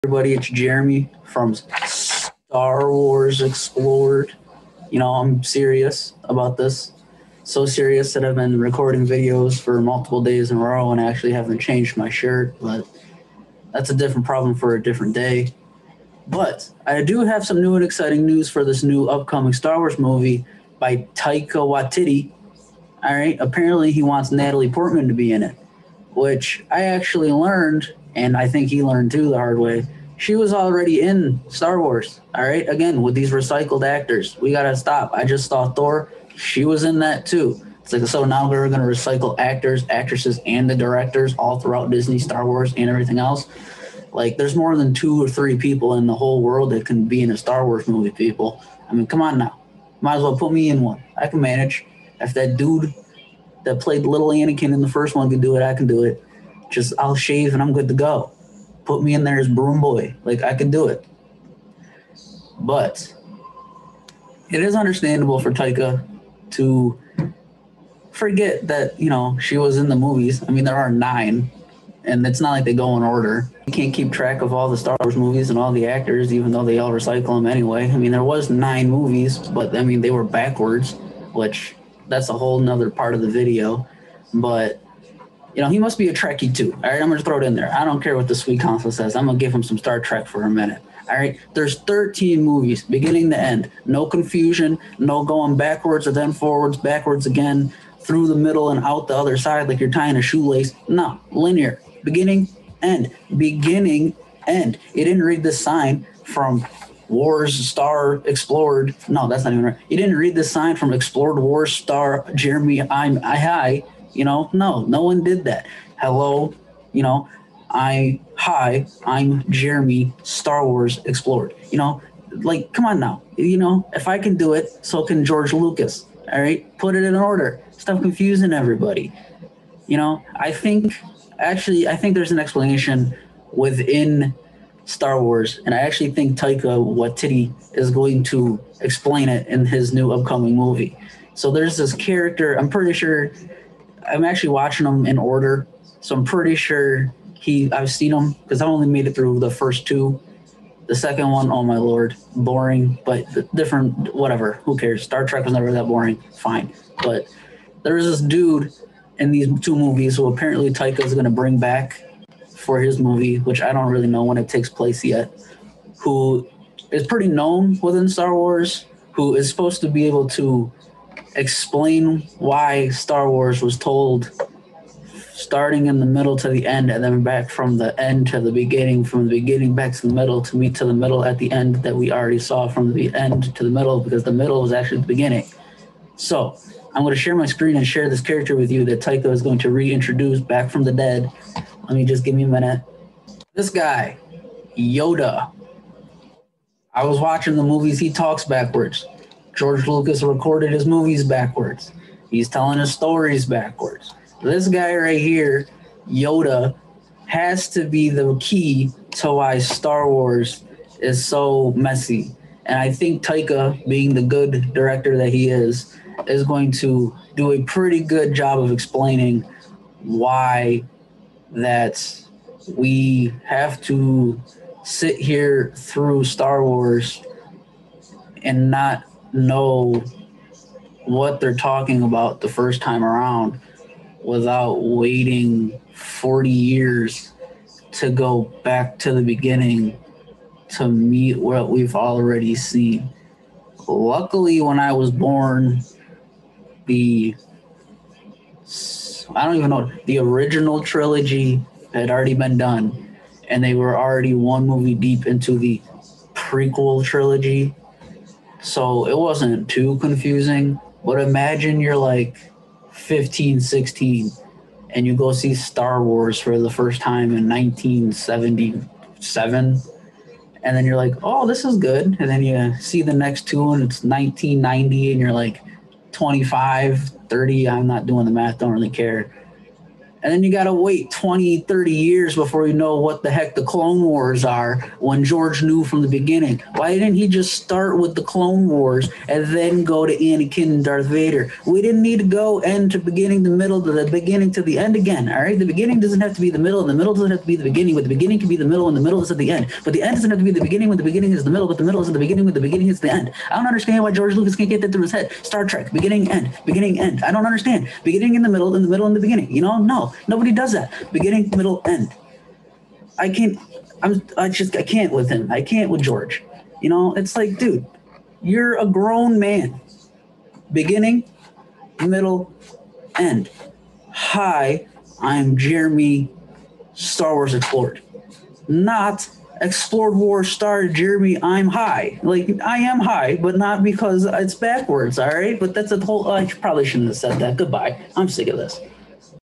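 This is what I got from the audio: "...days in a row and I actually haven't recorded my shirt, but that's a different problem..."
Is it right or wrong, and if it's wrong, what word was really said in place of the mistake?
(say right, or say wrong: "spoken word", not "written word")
wrong: "changed", not "recorded".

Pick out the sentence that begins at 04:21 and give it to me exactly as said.
But imagine you're like 15, 16, and you go see Star Wars for the first time in 1977.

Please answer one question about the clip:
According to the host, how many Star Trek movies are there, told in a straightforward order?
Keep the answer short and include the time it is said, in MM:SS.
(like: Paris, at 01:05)
13, at 01:31.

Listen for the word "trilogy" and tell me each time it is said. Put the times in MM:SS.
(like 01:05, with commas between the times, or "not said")
04:10, 04:17.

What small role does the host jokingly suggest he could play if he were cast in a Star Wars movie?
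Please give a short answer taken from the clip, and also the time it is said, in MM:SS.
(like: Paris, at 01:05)
Broom boy, at 00:59.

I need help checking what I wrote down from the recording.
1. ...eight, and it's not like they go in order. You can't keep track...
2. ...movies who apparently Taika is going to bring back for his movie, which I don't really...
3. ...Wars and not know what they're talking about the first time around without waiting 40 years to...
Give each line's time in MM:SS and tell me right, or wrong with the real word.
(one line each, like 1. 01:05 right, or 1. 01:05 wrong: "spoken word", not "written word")
1. 01:10 wrong: "nine", not "eight"
2. 02:39 right
3. 03:46 right.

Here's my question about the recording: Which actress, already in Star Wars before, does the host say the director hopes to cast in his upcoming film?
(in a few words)
Natalie Portman.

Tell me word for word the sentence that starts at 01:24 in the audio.
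But you know, he must be a Trekkie too.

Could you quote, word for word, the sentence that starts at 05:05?
Star Trek, beginning, end, beginning, end.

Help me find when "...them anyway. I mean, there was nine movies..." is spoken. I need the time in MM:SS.
01:17.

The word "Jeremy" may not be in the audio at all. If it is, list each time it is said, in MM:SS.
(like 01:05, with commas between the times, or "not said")
00:00, 01:52, 01:59, 05:25, 05:30.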